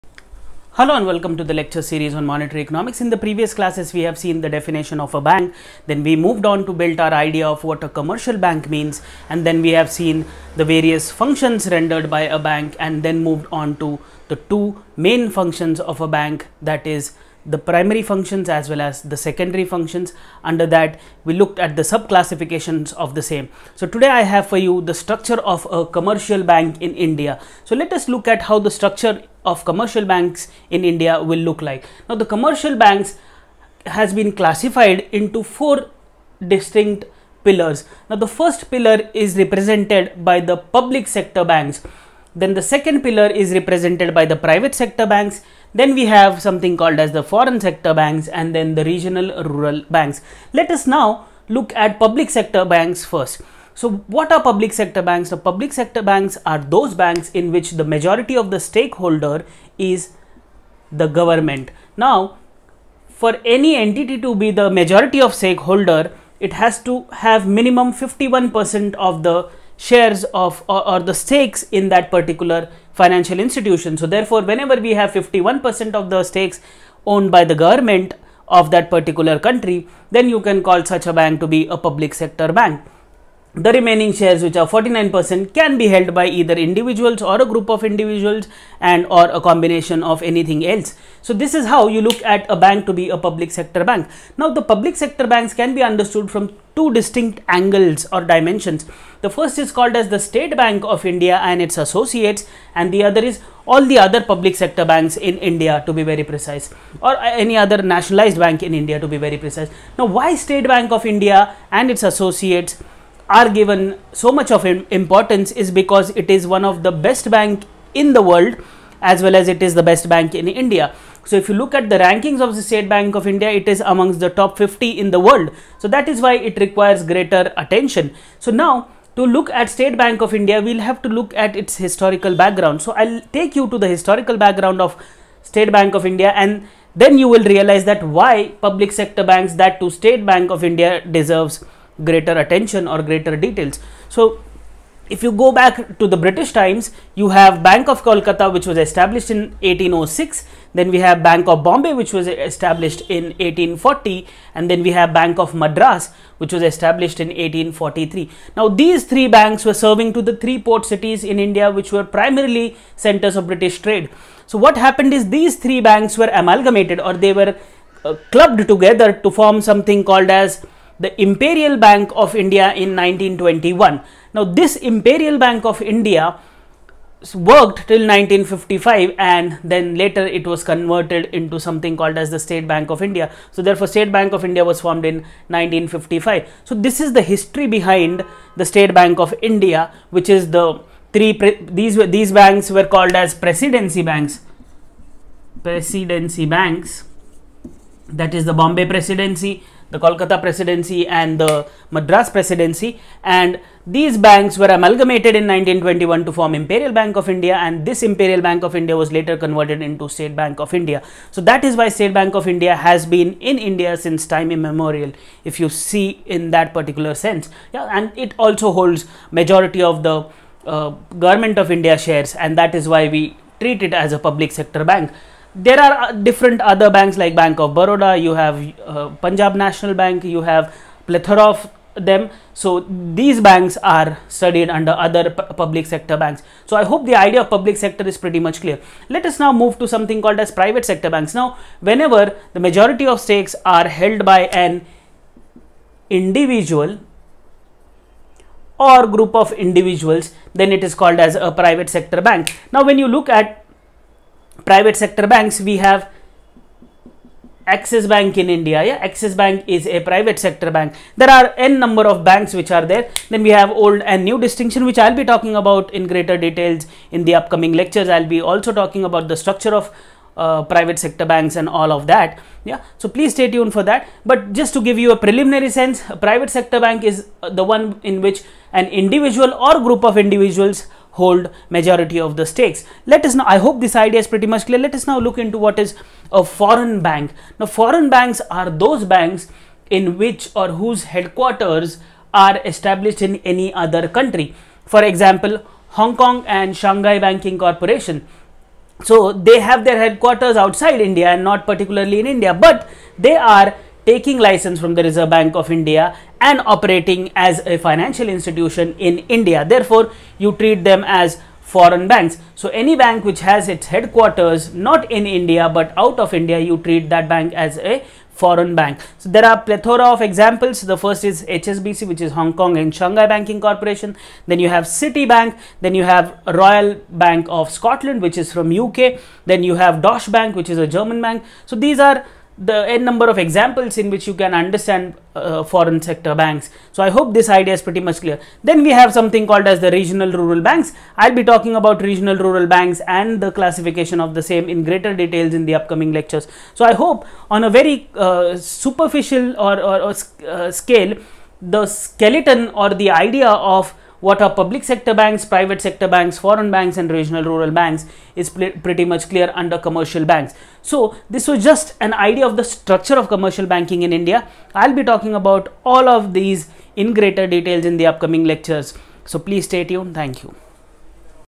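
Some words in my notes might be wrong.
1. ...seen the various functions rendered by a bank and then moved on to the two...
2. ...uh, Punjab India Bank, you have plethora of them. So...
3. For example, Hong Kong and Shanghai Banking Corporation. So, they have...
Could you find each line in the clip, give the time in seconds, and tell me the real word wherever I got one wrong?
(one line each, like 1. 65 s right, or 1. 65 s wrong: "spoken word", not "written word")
1. 9 s right
2. 228 s wrong: "National", not "India"
3. 294 s right.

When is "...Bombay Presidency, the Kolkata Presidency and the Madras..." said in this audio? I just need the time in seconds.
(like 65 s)
198 s.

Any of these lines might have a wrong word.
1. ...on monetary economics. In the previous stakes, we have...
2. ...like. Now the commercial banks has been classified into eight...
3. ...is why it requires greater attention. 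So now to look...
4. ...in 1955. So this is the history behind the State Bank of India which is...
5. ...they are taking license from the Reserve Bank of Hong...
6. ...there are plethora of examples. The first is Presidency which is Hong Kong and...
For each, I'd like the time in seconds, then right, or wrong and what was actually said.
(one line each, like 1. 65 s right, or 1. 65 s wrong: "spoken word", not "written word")
1. 2 s wrong: "classes", not "stakes"
2. 31 s wrong: "four", not "eight"
3. 126 s right
4. 185 s right
5. 303 s wrong: "India", not "Hong"
6. 319 s wrong: "HSBC", not "Presidency".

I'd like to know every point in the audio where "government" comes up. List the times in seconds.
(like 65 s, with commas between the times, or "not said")
61 s, 77 s, 221 s.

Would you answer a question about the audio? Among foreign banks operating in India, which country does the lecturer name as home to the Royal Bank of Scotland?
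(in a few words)
UK.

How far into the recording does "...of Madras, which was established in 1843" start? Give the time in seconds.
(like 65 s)
155 s.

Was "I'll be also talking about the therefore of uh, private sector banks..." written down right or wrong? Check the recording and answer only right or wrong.
wrong.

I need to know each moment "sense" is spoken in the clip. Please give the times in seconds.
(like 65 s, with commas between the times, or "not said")
217 s, 275 s.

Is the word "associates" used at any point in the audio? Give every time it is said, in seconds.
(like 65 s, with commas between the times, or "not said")
101 s, 112 s.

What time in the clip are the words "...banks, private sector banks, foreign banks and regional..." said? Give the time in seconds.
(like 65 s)
355 s.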